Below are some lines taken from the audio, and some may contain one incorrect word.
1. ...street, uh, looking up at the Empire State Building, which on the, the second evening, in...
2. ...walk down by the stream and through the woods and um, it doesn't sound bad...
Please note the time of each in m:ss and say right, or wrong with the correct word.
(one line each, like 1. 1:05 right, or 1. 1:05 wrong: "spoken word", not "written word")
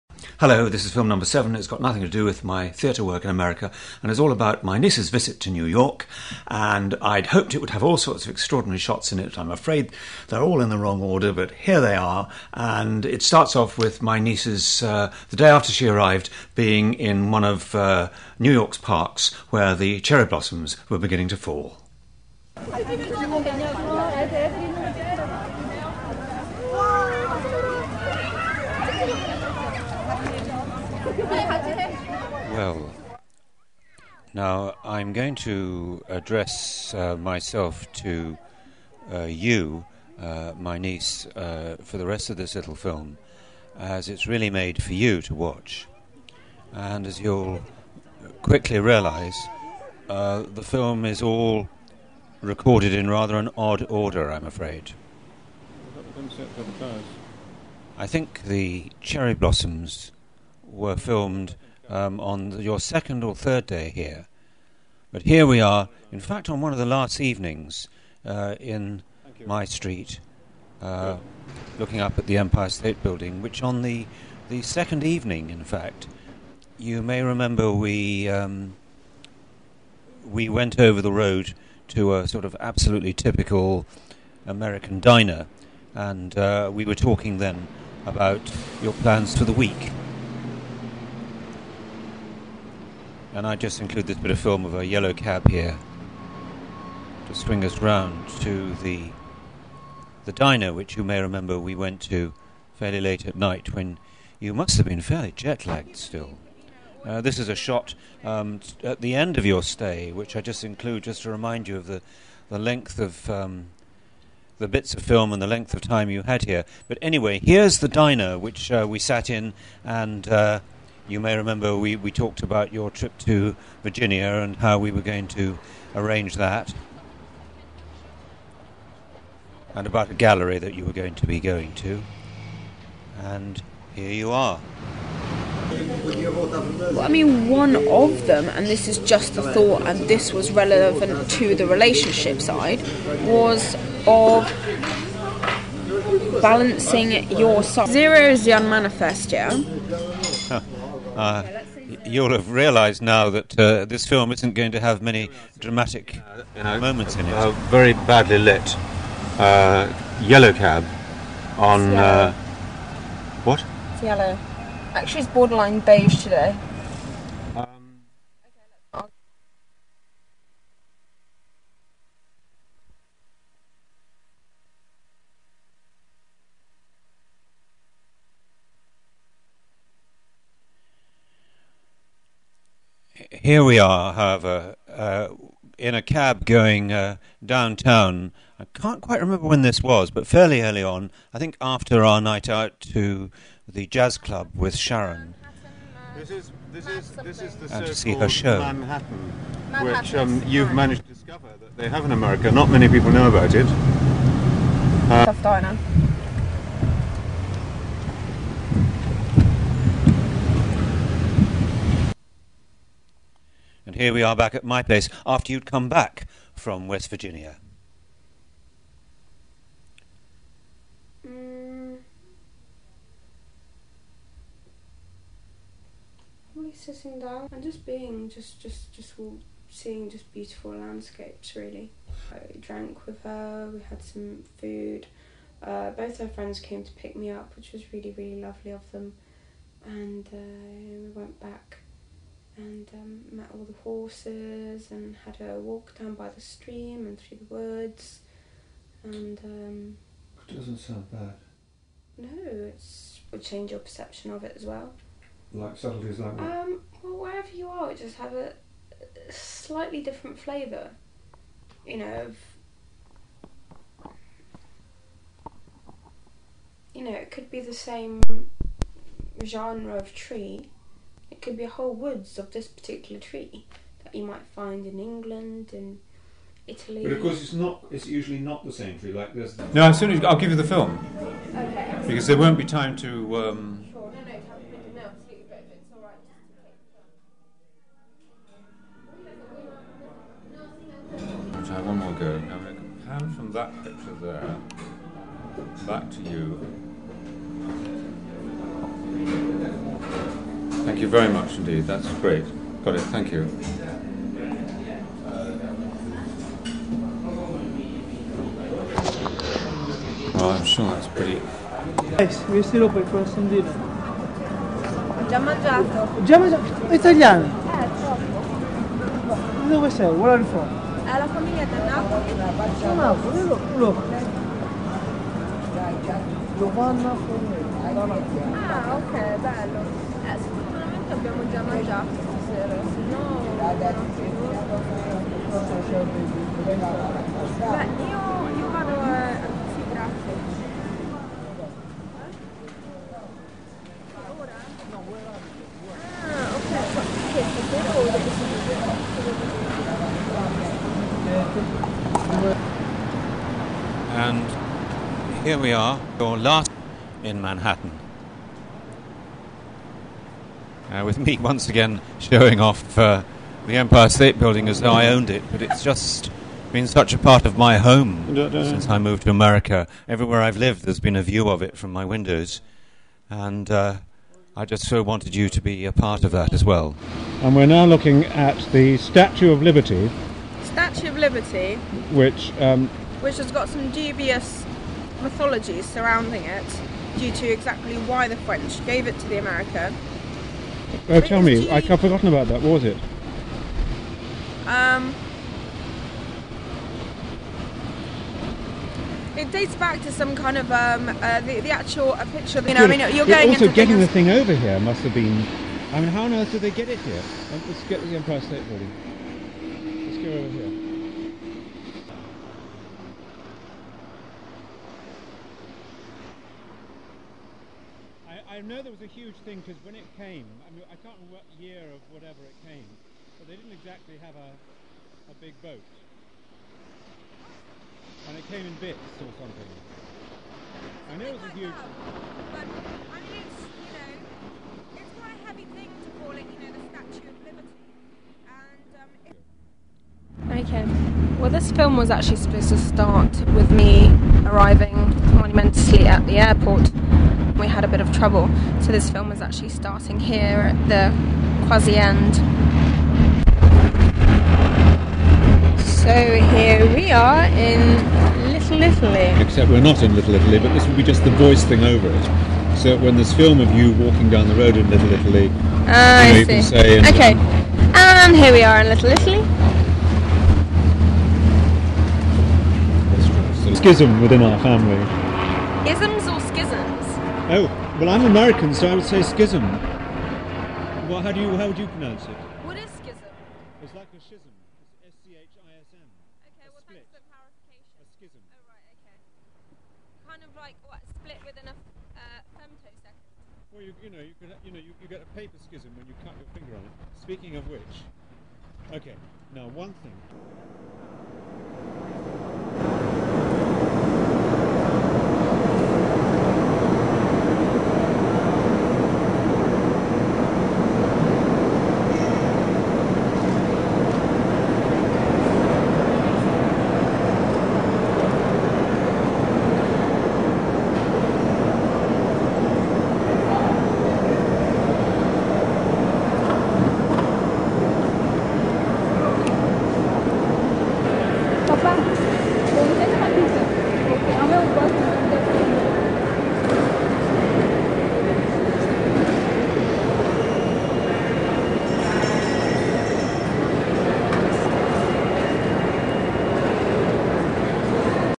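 1. 1:09 right
2. 4:05 right.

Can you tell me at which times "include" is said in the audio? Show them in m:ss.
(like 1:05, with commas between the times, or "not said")
1:33, 1:50.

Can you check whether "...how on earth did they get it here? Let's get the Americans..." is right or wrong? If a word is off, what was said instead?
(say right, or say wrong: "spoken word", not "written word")
wrong: "Empire", not "Americans".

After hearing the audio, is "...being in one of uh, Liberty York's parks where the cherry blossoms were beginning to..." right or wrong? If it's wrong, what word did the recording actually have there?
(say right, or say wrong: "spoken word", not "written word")
wrong: "New", not "Liberty".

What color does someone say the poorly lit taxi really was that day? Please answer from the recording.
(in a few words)
Beige.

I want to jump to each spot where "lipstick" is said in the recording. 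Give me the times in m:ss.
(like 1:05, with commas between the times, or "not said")
not said.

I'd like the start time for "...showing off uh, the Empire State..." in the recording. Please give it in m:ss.
6:02.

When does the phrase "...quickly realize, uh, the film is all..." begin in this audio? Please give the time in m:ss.
0:48.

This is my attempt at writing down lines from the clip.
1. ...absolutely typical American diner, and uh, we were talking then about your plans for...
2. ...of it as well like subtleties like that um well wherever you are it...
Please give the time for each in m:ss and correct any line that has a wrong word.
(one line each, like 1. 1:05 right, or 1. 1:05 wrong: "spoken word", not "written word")
1. 1:22 right
2. 4:14 right.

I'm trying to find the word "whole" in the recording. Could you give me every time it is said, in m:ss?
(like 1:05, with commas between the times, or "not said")
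4:31.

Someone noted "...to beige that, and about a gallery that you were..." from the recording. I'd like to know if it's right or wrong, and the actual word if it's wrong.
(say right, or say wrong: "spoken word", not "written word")
wrong: "arrange", not "beige".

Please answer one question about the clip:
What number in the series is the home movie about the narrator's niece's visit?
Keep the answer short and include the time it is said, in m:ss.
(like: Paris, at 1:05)
7, at 0:01.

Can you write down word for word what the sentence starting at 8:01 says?
Well, how do you how would you pronounce it?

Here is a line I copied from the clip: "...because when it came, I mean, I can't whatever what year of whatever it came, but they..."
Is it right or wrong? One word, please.
wrong.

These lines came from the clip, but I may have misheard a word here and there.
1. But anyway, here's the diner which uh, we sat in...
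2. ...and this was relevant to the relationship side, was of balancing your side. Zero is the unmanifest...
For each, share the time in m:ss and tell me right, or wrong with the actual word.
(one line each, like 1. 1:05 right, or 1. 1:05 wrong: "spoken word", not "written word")
1. 1:56 right
2. 2:19 right.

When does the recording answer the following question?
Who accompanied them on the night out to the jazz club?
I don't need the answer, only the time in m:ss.
3:14.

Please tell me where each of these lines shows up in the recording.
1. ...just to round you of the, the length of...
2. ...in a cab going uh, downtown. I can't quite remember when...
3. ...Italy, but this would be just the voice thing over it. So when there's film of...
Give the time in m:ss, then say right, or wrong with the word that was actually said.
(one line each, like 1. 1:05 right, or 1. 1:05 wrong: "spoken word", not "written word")
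1. 1:51 wrong: "remind", not "round"
2. 3:05 right
3. 7:40 right.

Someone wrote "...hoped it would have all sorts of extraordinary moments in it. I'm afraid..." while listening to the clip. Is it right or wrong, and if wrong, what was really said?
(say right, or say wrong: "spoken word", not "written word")
wrong: "shots", not "moments".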